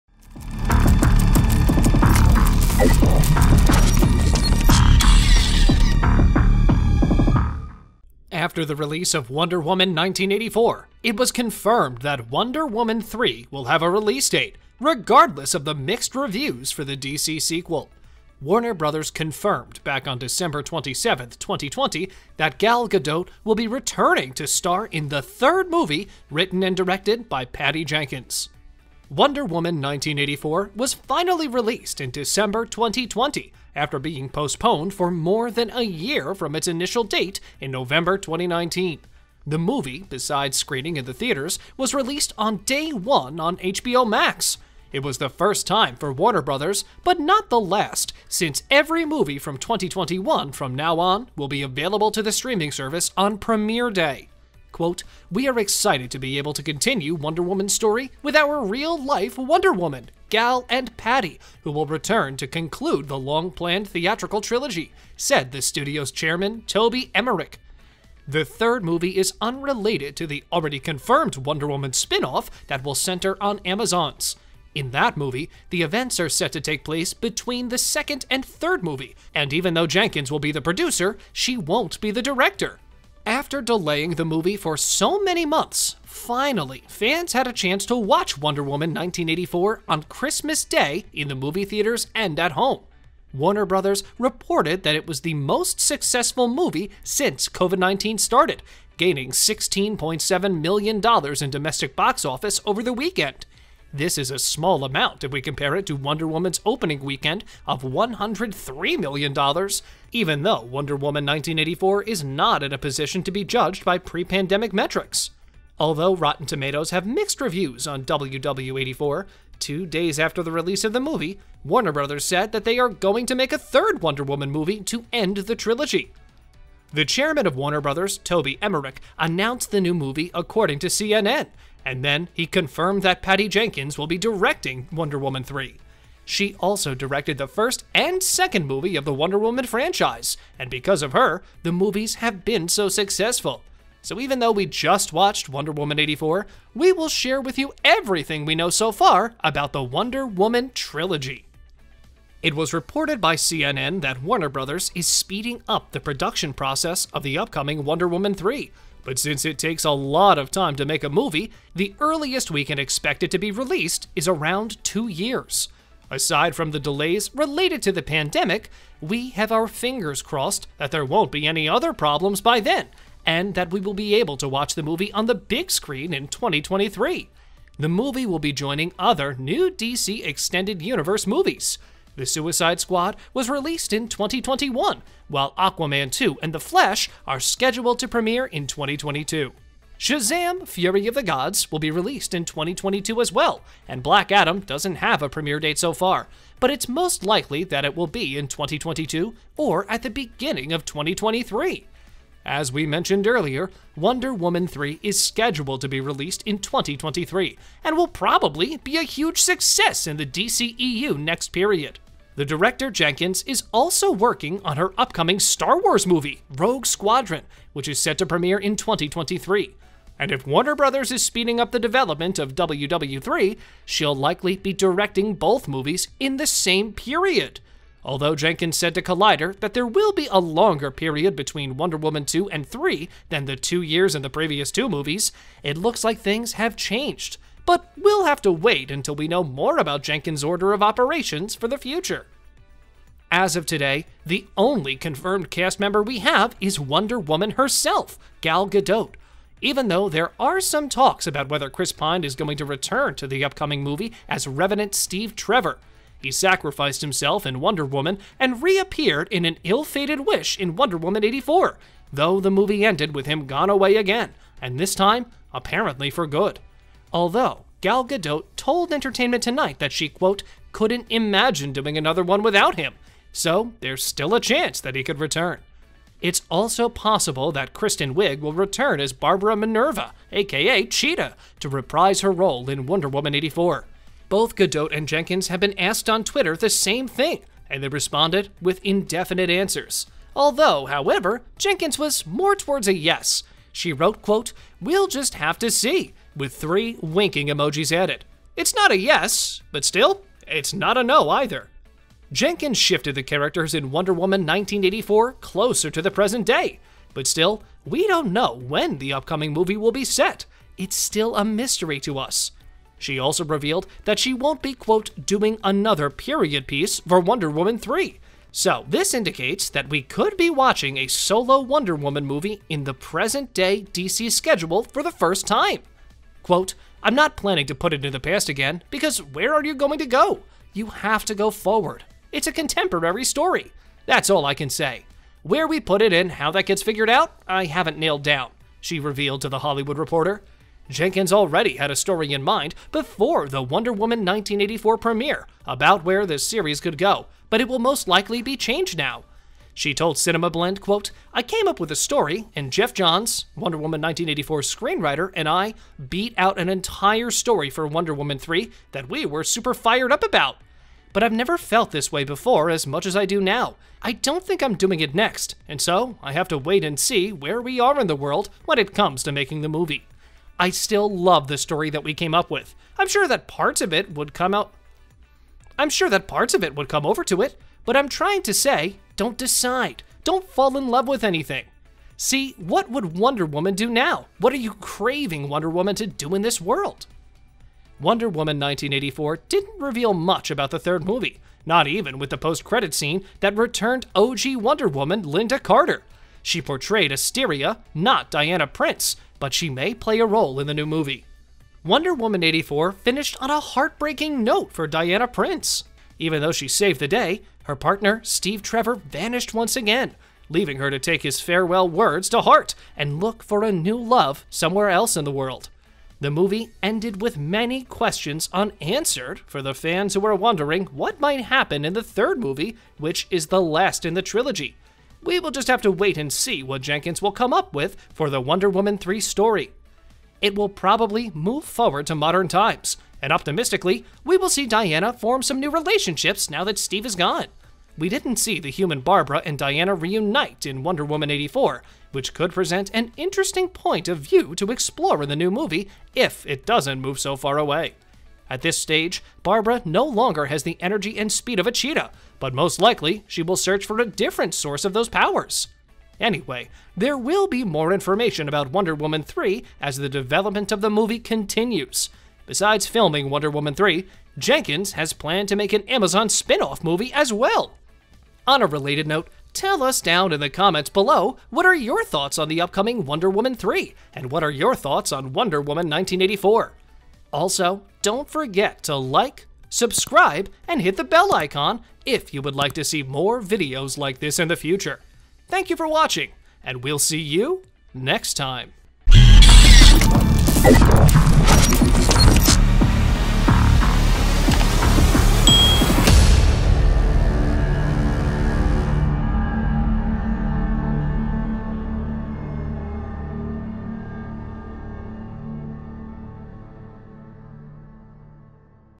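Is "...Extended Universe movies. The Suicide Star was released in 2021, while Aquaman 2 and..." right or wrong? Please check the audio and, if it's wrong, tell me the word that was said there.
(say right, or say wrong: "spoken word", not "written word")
wrong: "Squad", not "Star".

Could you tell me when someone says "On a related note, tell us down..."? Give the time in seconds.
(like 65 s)
468 s.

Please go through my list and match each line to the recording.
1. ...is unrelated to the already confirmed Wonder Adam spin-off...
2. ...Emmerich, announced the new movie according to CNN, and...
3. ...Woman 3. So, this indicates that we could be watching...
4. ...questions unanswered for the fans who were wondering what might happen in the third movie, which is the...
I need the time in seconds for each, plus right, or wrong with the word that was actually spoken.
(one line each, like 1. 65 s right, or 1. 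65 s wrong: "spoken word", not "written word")
1. 69 s wrong: "Woman", not "Adam"
2. 128 s right
3. 317 s right
4. 417 s right.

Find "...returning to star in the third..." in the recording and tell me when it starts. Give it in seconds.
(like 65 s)
23 s.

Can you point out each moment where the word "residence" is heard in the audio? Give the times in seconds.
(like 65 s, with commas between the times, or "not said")
not said.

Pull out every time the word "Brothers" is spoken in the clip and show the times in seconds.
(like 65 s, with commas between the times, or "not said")
18 s, 46 s, 93 s, 121 s, 127 s, 154 s, 220 s.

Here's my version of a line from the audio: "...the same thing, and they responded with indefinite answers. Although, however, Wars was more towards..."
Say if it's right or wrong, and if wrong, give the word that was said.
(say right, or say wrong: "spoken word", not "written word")
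wrong: "Jenkins", not "Wars".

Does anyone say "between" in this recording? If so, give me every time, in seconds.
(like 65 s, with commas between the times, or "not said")
77 s, 231 s.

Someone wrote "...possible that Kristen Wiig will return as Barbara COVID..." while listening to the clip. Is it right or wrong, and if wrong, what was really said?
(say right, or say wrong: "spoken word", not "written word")
wrong: "Minerva", not "COVID".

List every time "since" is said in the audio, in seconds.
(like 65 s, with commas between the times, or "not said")
48 s, 97 s, 159 s.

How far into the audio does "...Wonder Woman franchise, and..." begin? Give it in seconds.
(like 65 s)
139 s.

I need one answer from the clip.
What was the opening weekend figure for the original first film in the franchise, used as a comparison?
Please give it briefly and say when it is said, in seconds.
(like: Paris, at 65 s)
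$103 million, at 107 s.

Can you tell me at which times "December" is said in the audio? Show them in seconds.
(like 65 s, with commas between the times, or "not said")
20 s, 32 s.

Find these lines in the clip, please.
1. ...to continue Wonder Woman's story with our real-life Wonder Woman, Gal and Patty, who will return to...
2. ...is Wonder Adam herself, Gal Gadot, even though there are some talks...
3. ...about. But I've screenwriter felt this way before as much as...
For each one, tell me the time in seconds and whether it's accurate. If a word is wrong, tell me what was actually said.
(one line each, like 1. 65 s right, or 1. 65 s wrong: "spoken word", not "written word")
1. 56 s right
2. 246 s wrong: "Woman", not "Adam"
3. 360 s wrong: "never", not "screenwriter".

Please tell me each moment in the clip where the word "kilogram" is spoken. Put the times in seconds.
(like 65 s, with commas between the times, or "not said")
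not said.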